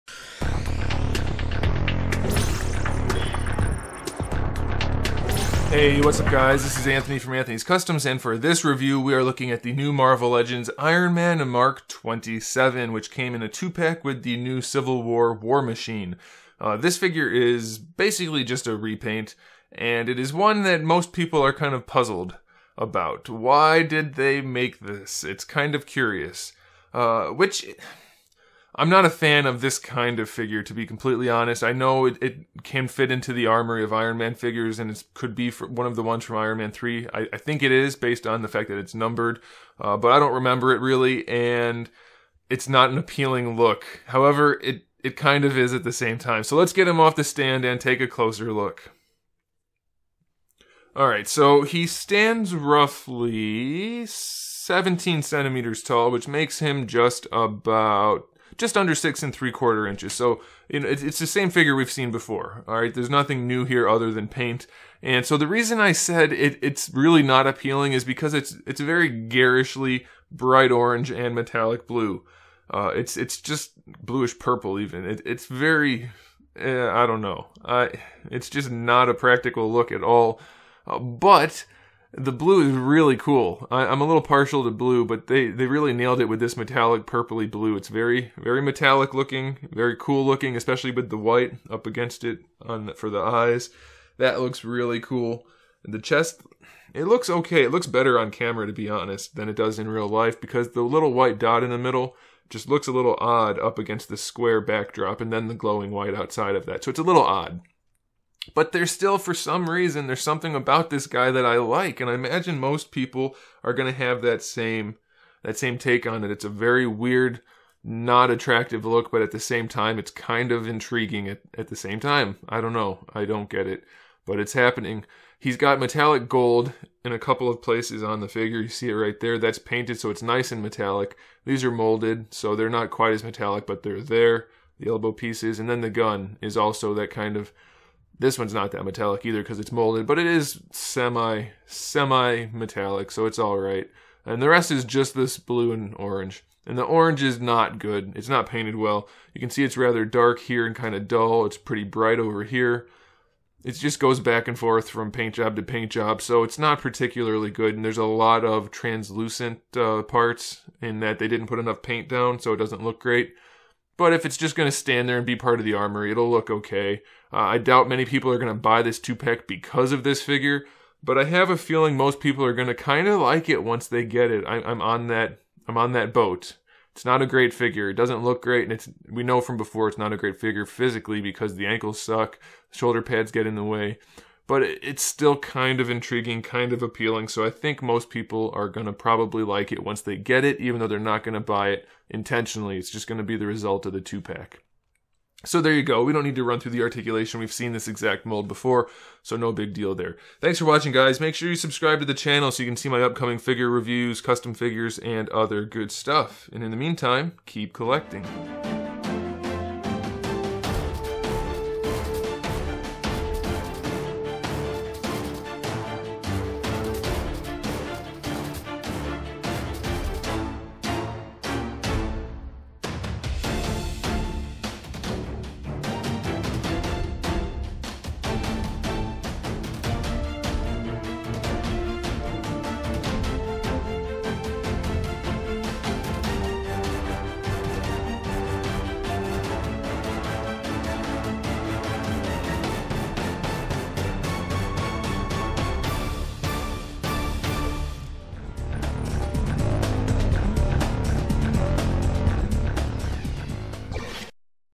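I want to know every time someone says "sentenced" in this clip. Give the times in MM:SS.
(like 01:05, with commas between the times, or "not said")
not said.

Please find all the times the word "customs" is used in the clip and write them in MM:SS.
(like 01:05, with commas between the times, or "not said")
00:07, 03:24.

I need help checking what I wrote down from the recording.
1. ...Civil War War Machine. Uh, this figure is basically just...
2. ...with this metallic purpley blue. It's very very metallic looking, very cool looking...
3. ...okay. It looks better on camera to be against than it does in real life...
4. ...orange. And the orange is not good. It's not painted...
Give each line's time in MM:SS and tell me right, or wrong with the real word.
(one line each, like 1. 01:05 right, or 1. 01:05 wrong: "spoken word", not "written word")
1. 00:14 right
2. 01:26 right
3. 01:37 wrong: "honest", not "against"
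4. 02:25 right.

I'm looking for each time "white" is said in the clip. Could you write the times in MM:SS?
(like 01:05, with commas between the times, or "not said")
01:31, 01:41, 01:45.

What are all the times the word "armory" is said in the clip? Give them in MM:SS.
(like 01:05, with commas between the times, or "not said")
00:33, 02:45.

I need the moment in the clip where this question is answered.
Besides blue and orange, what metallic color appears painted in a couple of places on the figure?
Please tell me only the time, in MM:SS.
02:06.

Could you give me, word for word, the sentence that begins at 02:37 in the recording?
And there's a lot of translucent uh, parts in that they didn't put enough paint down, so it doesn't look great.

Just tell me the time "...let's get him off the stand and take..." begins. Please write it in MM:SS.
00:46.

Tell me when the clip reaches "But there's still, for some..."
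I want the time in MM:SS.
01:48.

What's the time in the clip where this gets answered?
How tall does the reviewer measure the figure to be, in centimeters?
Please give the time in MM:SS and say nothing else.
00:54.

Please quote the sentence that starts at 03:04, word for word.
But it's still kind of intriguing, kind of appealing.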